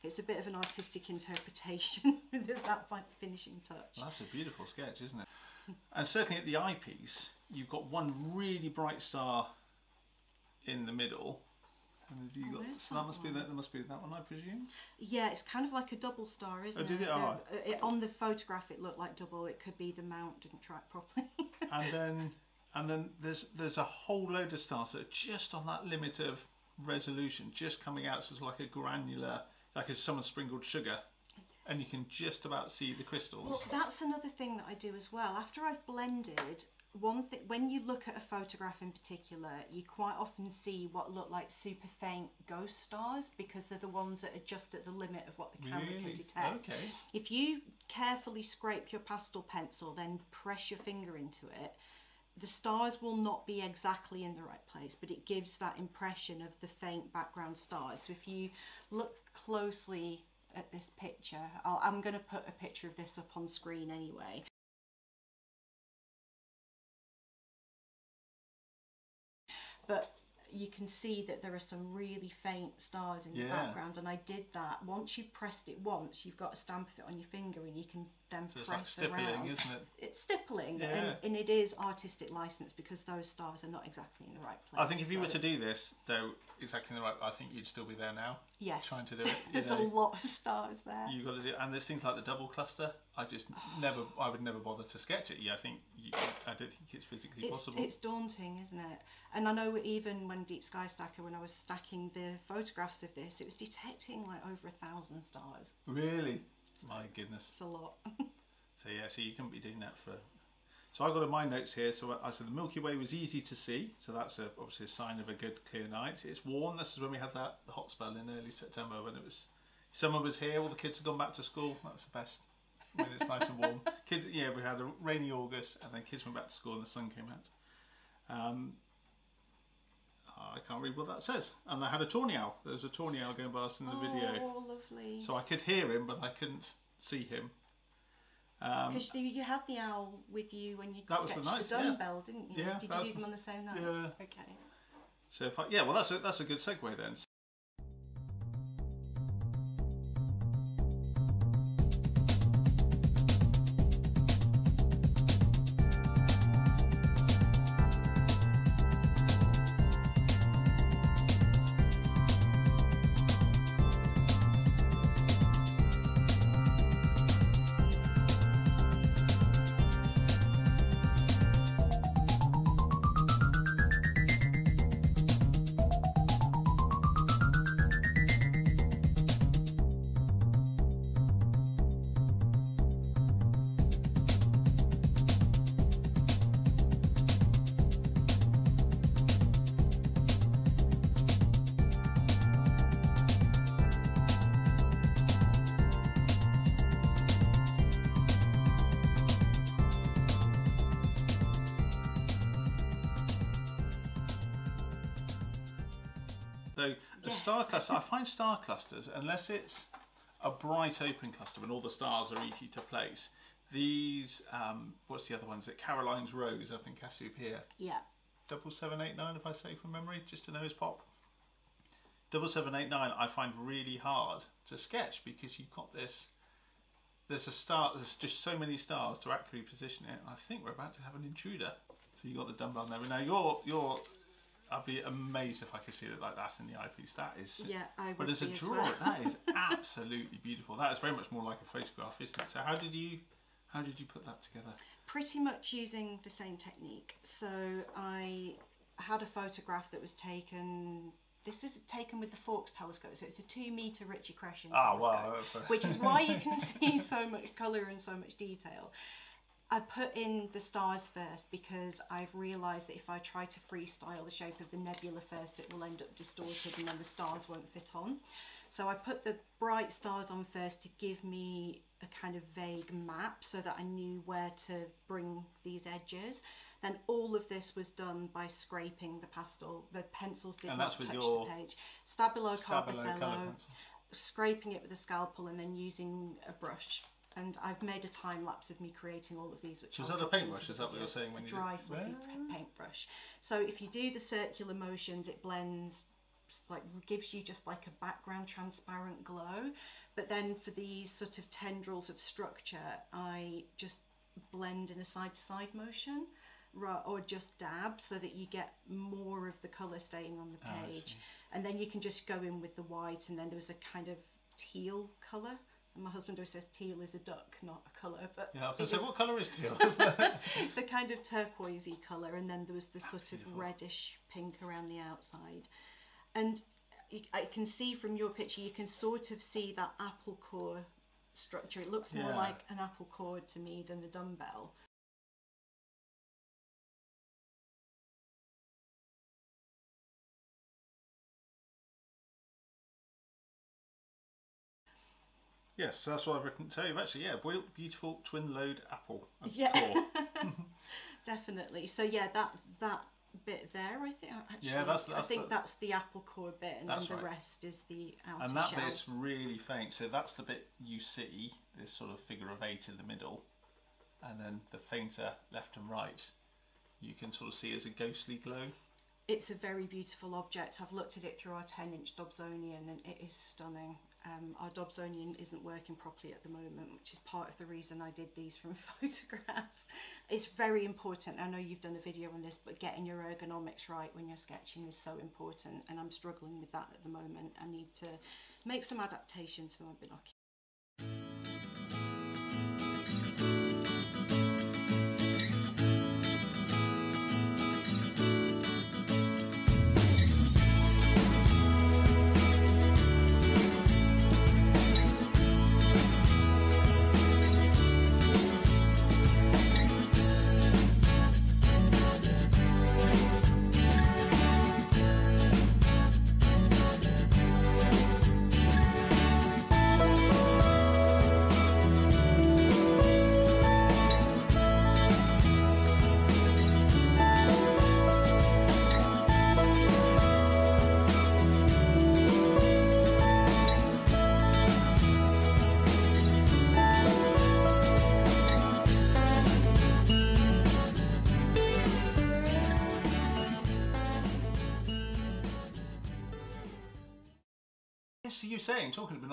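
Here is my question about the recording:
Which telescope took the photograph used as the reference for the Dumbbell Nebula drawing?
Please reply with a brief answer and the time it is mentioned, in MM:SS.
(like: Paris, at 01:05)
Faulkes telescope, at 04:12.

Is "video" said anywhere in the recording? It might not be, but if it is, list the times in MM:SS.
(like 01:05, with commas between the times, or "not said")
02:13, 06:22.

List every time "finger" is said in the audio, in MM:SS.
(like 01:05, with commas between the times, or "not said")
00:50, 01:17.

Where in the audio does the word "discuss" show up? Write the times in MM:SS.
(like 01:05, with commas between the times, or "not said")
not said.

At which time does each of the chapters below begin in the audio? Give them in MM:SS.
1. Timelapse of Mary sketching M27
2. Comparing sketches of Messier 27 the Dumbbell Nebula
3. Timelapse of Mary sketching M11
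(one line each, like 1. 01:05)
1. 06:30
2. 03:30
3. 02:28.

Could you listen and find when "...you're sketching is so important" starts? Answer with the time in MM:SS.
06:24.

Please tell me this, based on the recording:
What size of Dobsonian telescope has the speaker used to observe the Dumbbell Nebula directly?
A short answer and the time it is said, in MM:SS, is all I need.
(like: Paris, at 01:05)
10 inch, at 06:11.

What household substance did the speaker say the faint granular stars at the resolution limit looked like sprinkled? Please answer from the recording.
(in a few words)
Sugar.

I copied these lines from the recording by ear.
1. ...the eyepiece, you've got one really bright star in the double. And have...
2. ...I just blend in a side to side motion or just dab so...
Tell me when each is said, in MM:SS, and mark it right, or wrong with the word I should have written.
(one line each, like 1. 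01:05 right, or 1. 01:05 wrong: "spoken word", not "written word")
1. 00:06 wrong: "middle", not "double"
2. 05:03 right.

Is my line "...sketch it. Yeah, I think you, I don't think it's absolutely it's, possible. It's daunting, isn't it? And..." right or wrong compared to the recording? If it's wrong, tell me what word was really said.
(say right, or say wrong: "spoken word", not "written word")
wrong: "physically", not "absolutely".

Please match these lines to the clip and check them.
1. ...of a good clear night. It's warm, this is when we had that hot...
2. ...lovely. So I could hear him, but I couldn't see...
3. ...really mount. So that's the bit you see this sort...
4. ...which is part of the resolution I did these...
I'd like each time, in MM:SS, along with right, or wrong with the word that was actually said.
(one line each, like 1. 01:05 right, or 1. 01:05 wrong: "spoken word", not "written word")
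1. 01:55 right
2. 02:14 right
3. 05:59 wrong: "faint", not "mount"
4. 06:16 wrong: "reason", not "resolution".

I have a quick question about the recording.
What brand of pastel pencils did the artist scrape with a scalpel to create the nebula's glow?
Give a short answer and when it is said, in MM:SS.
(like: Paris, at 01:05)
Stabilo CarbOthello, at 04:42.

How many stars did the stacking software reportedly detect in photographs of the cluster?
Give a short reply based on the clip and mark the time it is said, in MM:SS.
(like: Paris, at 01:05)
Over 1,000, at 01:44.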